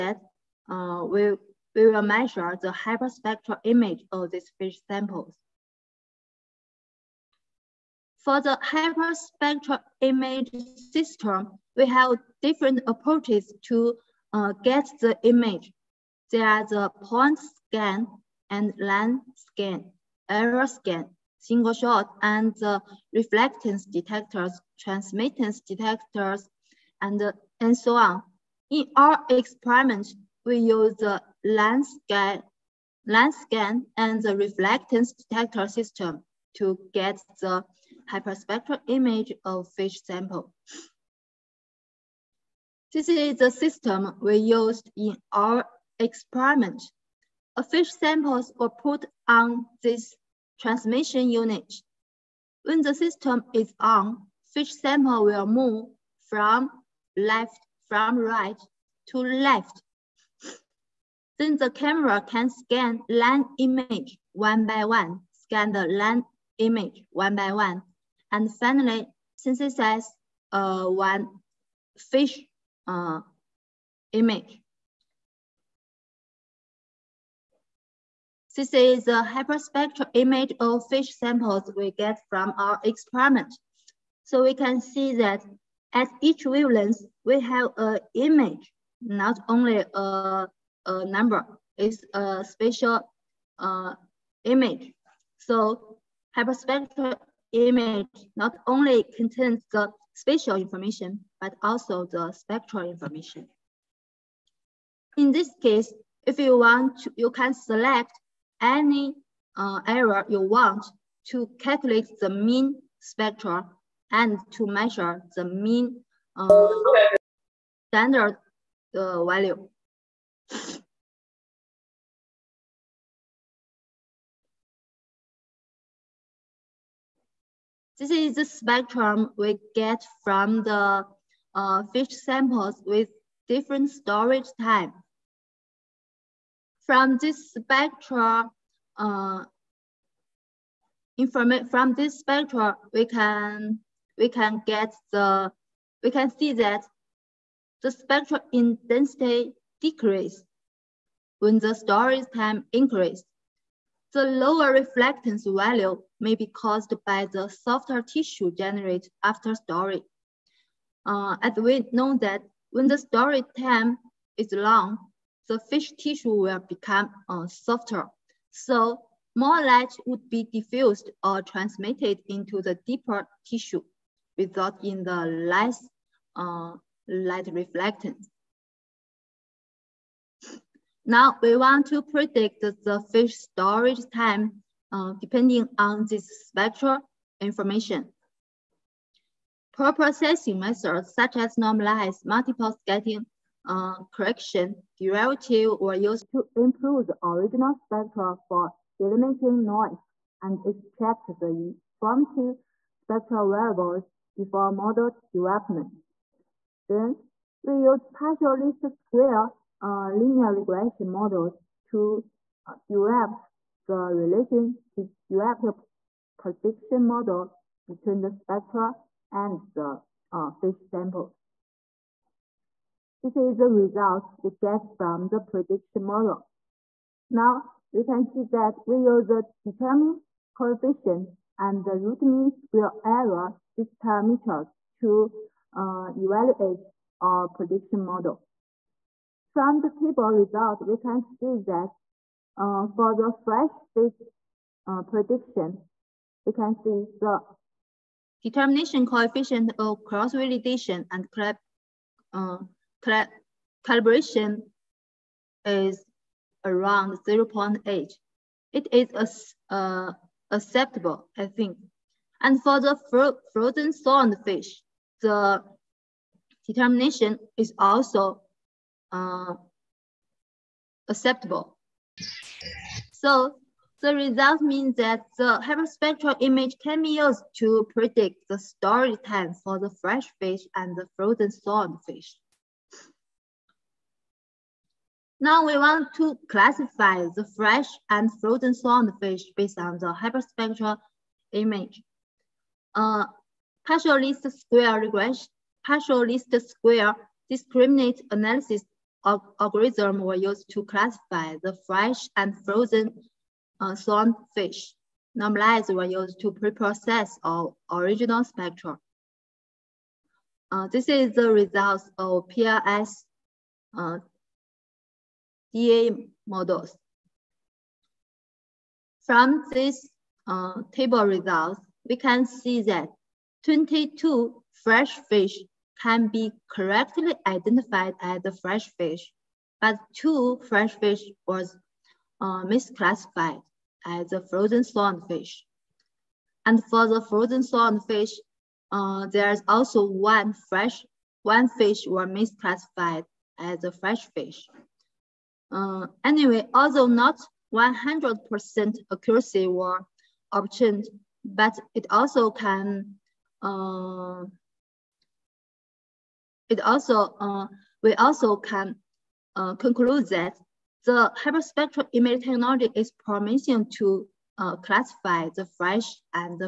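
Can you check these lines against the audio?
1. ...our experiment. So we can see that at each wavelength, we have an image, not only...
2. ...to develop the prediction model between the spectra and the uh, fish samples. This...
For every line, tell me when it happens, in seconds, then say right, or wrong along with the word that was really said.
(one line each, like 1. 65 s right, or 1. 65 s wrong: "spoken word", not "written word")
1. 82 s right
2. 214 s right.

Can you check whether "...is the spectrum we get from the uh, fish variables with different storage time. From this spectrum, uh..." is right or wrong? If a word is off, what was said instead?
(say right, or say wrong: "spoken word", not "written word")
wrong: "samples", not "variables".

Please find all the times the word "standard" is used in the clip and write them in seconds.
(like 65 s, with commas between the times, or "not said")
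117 s.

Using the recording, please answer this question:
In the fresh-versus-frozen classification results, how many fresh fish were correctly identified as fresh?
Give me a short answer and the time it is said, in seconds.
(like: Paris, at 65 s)
22, at 323 s.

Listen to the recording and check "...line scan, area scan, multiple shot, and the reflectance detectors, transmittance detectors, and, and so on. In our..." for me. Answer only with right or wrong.
wrong.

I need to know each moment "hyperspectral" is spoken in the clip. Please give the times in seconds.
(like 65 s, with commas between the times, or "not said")
2 s, 8 s, 38 s, 79 s, 96 s, 275 s, 290 s, 361 s.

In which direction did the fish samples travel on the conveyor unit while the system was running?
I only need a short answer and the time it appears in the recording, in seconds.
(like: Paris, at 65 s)
Right to left, at 57 s.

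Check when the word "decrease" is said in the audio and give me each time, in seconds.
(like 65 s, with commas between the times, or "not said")
149 s.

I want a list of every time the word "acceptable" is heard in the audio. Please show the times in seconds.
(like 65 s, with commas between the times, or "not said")
260 s, 271 s.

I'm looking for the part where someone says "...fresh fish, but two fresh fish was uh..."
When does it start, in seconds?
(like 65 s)
328 s.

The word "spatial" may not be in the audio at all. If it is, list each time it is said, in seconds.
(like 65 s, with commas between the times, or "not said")
92 s, 100 s.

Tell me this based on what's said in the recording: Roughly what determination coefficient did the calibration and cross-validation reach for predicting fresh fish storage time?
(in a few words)
0.8.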